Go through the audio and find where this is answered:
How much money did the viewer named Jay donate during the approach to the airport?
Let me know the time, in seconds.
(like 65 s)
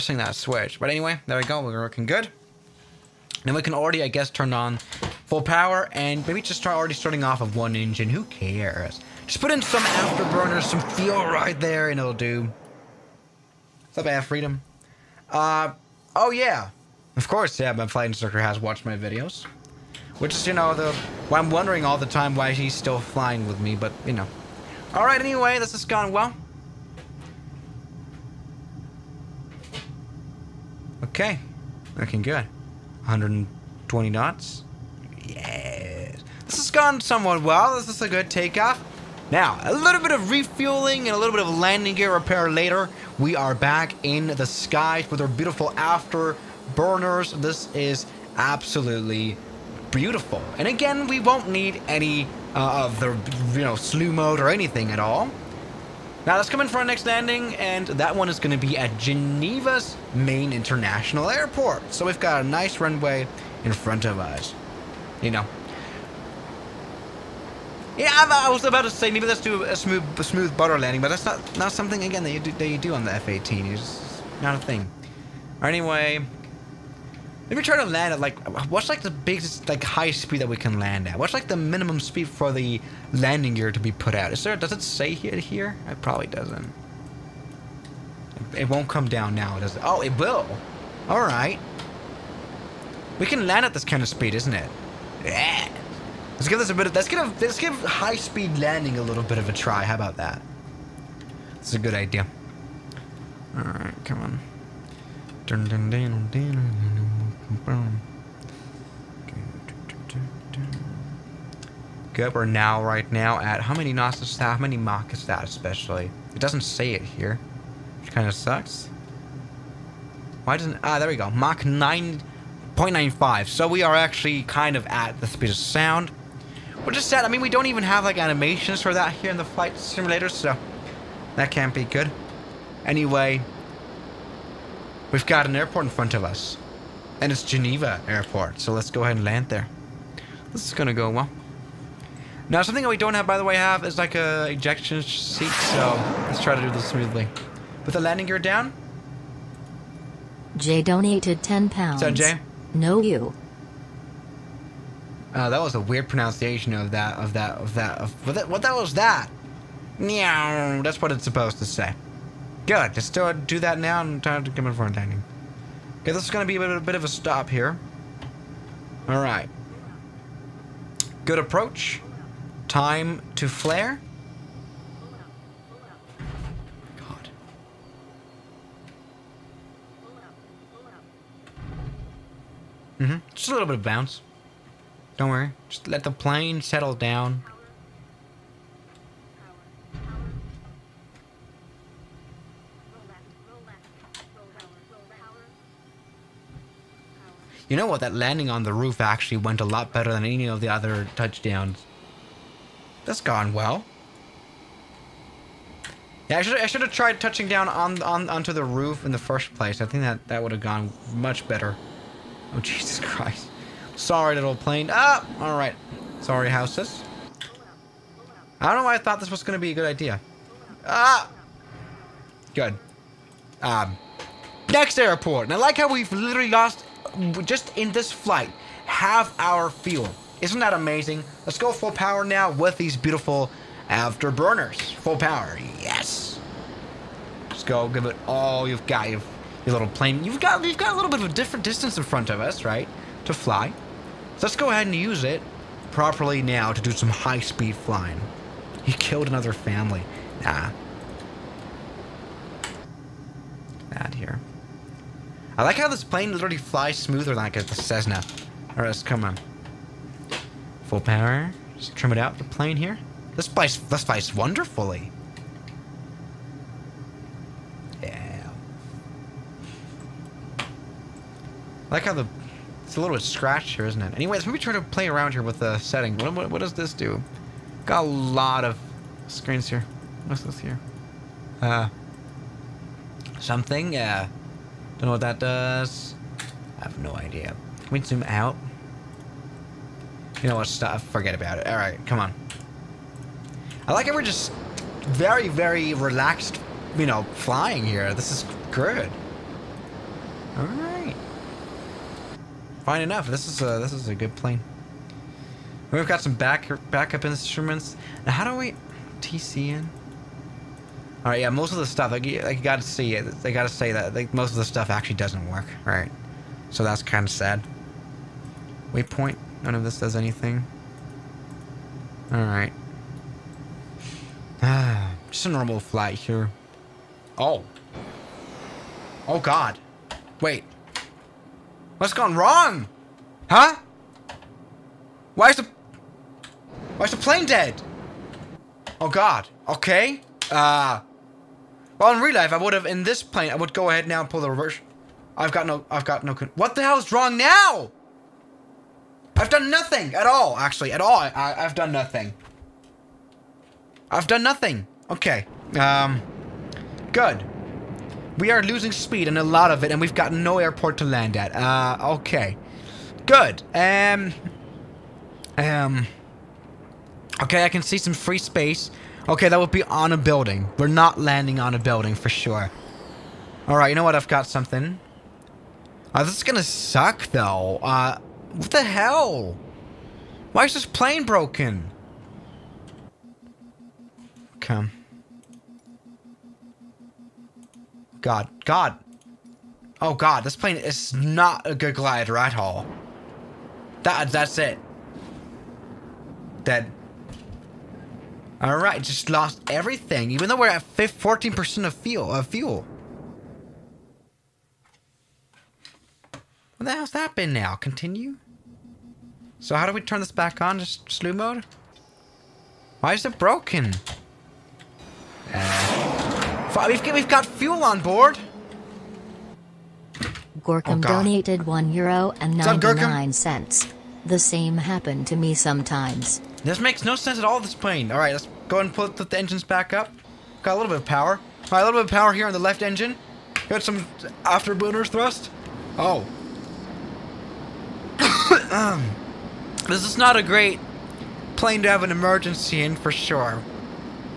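151 s.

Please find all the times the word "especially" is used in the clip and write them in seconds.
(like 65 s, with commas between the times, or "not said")
115 s.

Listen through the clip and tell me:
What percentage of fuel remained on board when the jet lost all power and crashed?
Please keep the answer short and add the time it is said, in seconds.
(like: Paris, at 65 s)
14%, at 400 s.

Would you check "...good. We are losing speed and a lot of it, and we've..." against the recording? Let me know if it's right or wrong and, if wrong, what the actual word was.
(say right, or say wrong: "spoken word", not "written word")
right.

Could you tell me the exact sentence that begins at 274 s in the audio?
Anyways, let maybe try to play around here with the setting.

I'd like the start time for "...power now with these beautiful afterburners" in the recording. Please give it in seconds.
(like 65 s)
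231 s.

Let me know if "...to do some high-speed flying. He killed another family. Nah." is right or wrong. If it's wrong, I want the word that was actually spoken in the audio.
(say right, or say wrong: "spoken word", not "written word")
right.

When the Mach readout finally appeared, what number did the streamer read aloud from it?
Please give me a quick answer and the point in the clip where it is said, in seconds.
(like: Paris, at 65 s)
9.95, at 121 s.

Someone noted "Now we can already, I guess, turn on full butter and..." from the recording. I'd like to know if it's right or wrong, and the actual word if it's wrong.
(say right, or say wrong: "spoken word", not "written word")
wrong: "power", not "butter".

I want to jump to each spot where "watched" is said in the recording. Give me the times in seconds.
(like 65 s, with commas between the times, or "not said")
18 s.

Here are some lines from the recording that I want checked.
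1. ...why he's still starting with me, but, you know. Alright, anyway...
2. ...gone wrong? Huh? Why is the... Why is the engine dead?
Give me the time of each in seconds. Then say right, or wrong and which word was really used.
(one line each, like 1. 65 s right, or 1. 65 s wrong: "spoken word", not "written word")
1. 22 s wrong: "flying", not "starting"
2. 332 s wrong: "plane", not "engine".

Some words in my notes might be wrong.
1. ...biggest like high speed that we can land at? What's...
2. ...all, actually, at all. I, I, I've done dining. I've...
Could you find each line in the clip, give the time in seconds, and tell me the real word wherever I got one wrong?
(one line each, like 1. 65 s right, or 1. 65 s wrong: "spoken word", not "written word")
1. 79 s right
2. 350 s wrong: "nothing", not "dining".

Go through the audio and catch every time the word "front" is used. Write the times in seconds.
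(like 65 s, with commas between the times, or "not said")
63 s, 135 s, 242 s.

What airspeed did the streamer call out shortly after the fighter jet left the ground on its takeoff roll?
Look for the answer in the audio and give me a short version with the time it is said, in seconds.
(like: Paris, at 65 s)
120 knots, at 33 s.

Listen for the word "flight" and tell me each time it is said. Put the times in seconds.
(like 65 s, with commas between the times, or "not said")
17 s, 129 s, 228 s, 325 s.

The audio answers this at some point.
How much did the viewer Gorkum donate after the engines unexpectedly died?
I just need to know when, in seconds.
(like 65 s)
421 s.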